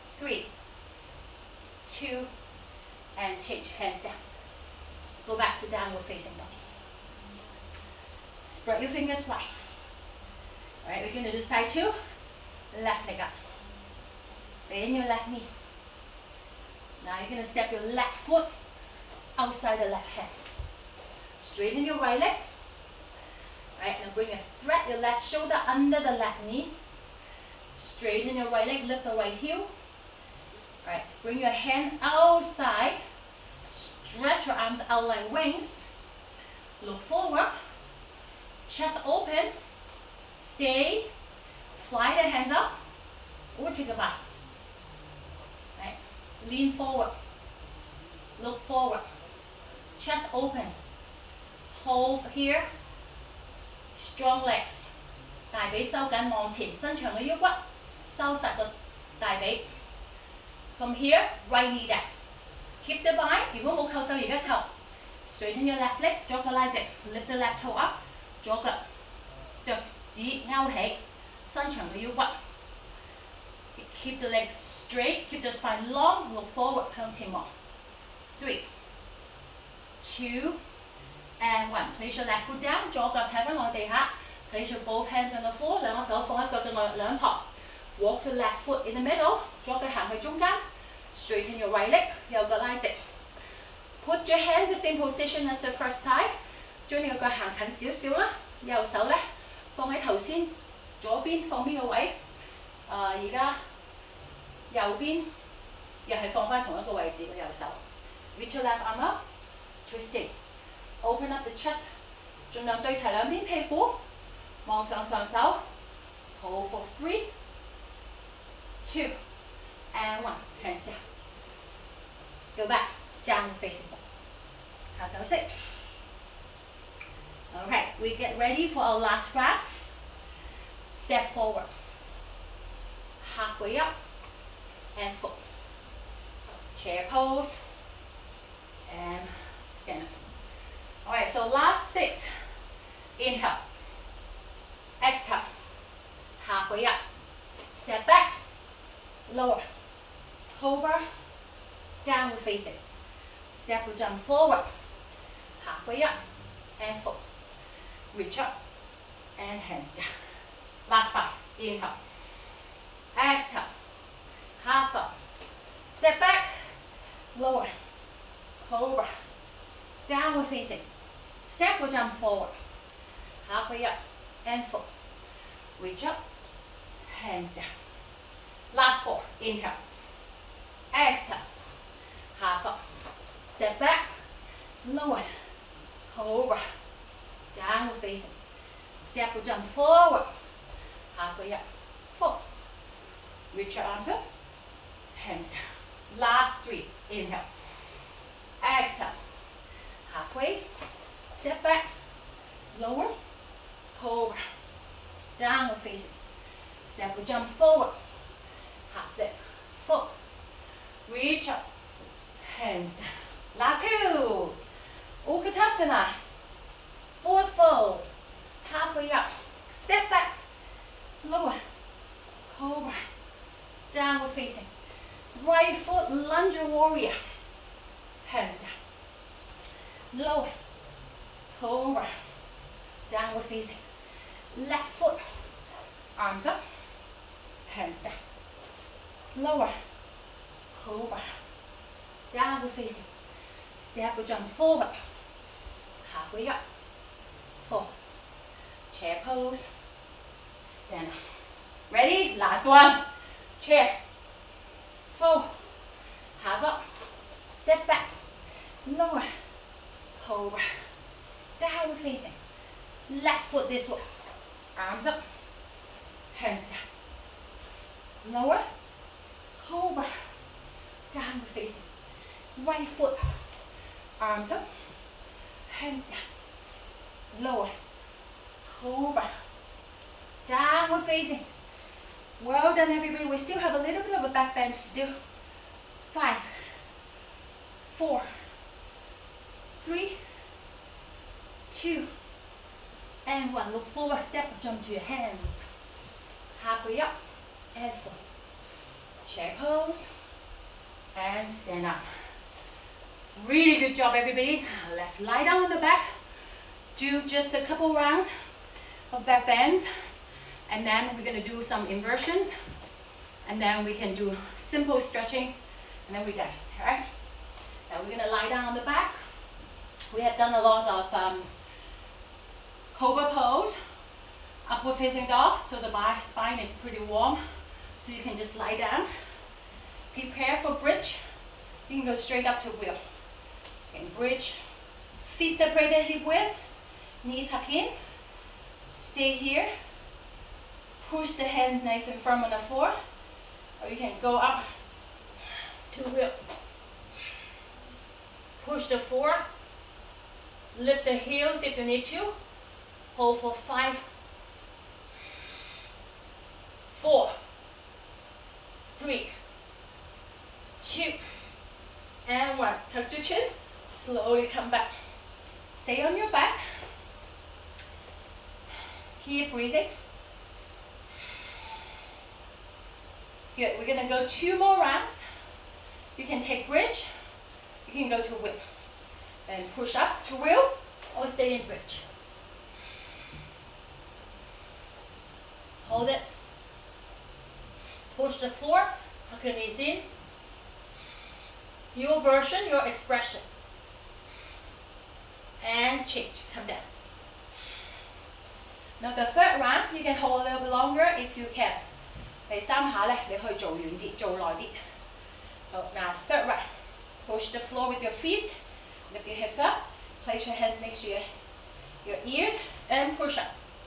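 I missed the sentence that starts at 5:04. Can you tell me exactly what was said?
Let's lie down on the back.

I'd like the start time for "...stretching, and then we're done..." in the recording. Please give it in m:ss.
5:14.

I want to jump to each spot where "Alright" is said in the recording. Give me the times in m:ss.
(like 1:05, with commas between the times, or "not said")
0:10.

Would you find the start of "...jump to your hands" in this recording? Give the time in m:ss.
4:54.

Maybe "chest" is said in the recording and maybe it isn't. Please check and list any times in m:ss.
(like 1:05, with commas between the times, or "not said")
0:38, 0:49, 1:51.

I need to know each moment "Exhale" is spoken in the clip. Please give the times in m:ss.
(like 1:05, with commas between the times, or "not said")
2:25, 2:43, 3:00, 3:18.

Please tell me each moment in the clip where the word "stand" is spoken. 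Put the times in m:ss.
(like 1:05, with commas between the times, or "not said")
2:19, 4:10, 5:01.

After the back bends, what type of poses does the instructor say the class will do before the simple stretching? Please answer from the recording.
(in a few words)
Inversions.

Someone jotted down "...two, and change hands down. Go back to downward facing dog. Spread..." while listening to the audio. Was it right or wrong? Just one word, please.
right.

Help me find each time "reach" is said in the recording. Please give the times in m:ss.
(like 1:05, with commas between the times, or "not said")
2:38, 2:55, 3:13, 3:31.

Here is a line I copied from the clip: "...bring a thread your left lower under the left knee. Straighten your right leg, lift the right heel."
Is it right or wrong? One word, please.
wrong.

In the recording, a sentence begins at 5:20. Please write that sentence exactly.
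We have done a lot of um, Cobra pose, upward facing dog, so the back spine is pretty warm.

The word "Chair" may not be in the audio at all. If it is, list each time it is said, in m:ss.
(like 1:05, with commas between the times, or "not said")
2:16, 4:08, 4:13, 4:59.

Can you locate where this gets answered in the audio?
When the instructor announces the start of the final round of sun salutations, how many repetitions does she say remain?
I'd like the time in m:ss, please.
2:21.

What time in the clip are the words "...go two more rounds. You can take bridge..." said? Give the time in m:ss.
6:14.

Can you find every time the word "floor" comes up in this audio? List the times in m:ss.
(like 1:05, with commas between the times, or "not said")
5:42, 5:48, 6:28, 6:47.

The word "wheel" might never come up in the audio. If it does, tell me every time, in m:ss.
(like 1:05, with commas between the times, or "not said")
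5:32, 5:46, 6:20.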